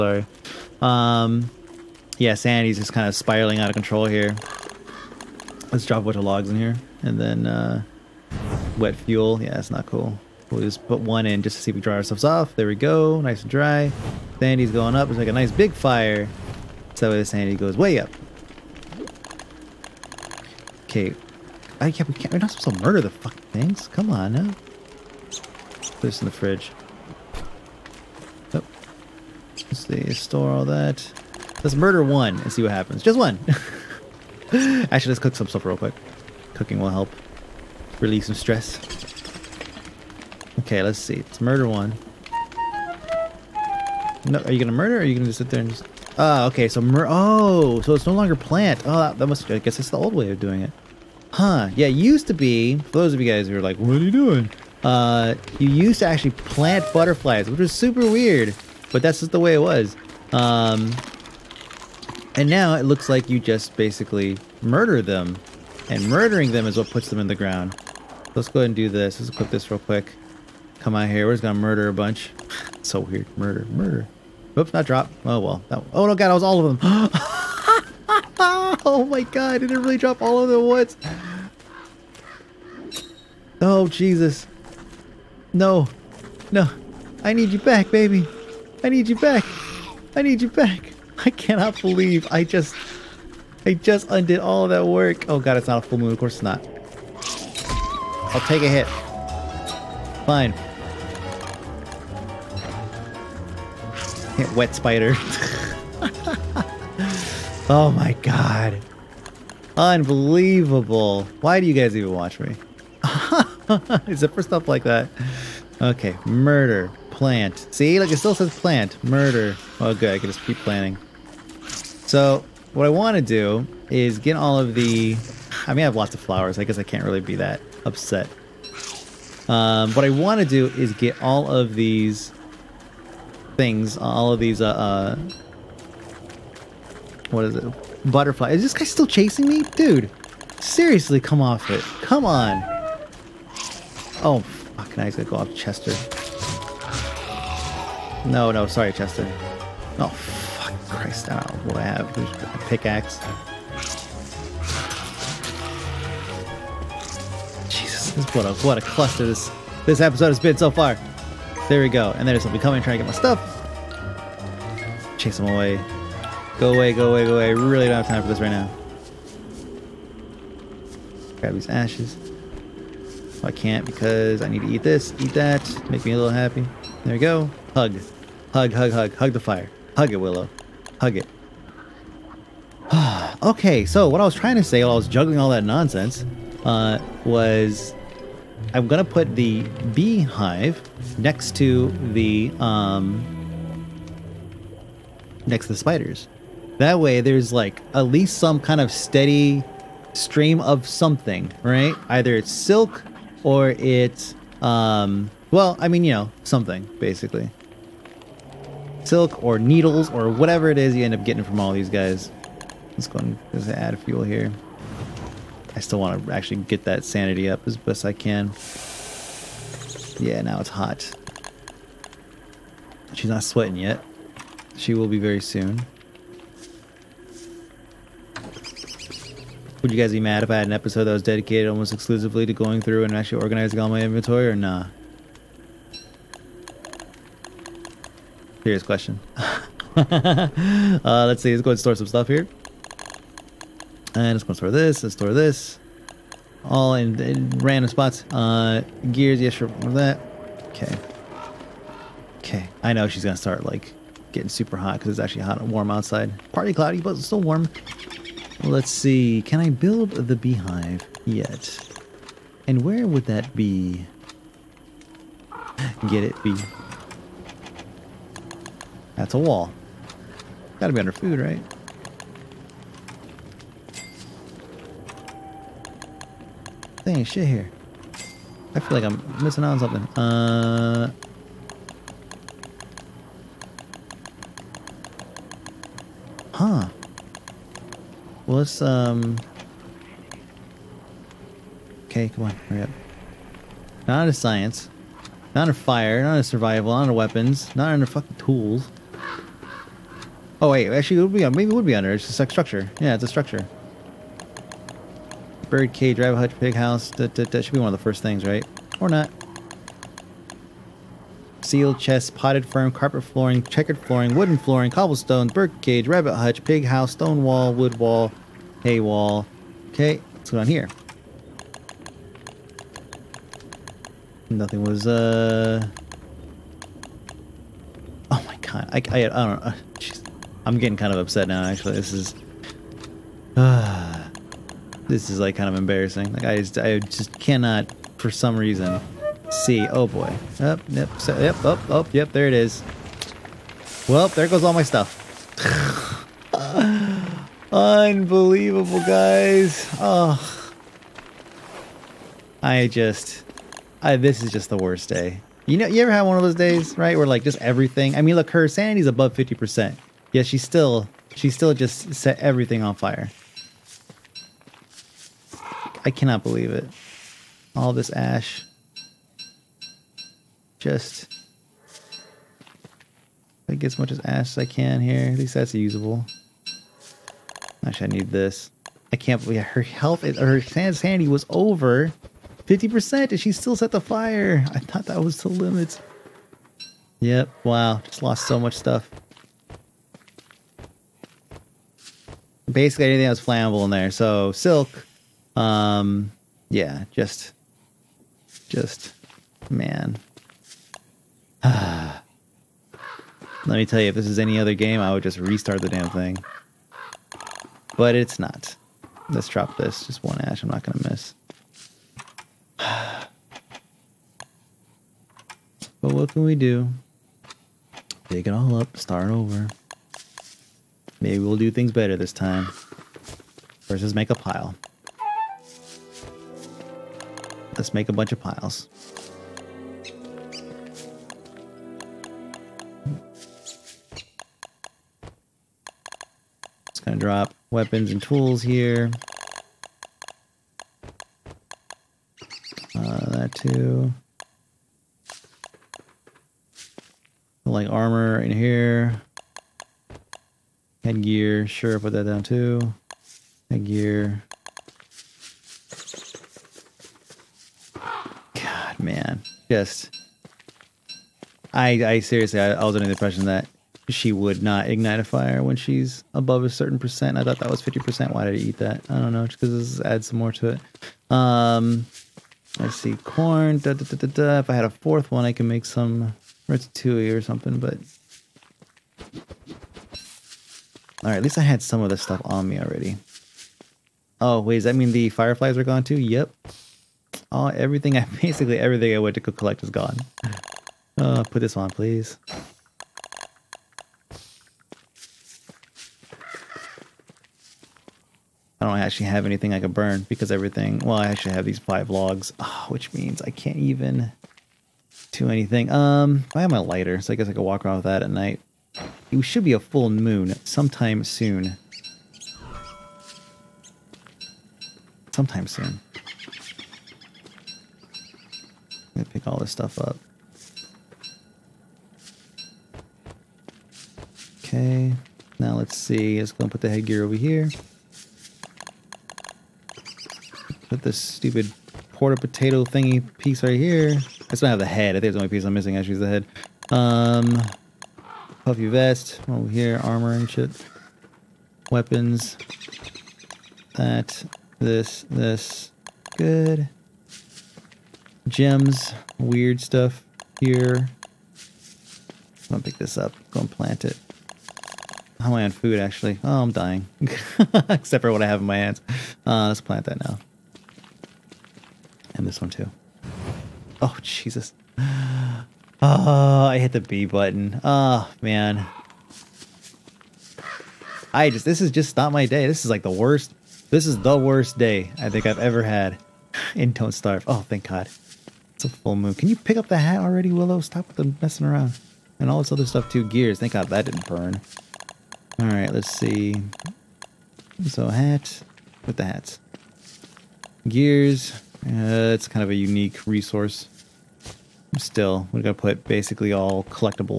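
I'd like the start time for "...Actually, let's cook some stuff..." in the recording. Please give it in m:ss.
0:34.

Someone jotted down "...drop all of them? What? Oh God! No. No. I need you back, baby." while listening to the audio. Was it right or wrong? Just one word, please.
wrong.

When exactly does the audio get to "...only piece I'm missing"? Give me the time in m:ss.
8:55.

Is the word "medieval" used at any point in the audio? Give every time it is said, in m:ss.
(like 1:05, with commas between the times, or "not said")
not said.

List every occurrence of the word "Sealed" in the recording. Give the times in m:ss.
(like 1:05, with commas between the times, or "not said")
5:11.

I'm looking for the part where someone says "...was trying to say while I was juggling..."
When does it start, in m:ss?
3:04.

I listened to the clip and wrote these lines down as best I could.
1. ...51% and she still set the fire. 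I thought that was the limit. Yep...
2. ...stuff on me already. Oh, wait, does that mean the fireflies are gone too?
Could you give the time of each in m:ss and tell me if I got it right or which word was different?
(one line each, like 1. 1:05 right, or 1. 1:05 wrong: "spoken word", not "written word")
1. 6:22 wrong: "50", not "51"
2. 8:02 right.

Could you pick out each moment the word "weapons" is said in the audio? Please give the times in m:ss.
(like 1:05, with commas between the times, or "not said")
4:57, 7:17, 9:01.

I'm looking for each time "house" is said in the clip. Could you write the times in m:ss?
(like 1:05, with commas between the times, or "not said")
5:06, 5:16.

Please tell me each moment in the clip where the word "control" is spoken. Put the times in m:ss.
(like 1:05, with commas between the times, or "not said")
0:03.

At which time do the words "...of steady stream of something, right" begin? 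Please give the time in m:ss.
3:18.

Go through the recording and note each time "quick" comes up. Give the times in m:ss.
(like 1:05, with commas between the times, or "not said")
0:35, 1:09.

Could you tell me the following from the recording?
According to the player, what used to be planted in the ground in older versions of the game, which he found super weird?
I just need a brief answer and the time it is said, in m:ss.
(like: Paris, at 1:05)
Butterflies, at 0:56.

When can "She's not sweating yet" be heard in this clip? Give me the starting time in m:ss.
3:43.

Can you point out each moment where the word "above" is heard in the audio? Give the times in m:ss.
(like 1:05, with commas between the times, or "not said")
5:59, 7:46.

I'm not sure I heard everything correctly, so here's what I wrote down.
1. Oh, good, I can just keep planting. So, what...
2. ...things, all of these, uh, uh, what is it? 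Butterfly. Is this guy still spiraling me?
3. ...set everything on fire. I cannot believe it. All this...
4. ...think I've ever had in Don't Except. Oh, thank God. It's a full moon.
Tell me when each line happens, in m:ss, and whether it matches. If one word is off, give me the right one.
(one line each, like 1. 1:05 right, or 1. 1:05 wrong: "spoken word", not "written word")
1. 1:59 right
2. 2:13 wrong: "chasing", not "spiraling"
3. 6:02 right
4. 9:35 wrong: "Starve", not "Except".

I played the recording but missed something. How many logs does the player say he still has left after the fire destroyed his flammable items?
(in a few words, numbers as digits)
5.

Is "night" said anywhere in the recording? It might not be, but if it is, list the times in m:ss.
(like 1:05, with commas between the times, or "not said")
8:28.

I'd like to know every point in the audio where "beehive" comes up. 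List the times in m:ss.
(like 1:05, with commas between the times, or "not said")
3:09, 4:20.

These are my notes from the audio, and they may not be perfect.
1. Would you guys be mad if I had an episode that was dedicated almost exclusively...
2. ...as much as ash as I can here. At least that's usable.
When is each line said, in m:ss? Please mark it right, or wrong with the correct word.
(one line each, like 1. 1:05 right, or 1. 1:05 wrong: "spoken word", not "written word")
1. 3:49 right
2. 6:13 right.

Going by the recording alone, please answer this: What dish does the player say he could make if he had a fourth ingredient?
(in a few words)
Ratatouille.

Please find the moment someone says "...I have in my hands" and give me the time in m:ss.
9:18.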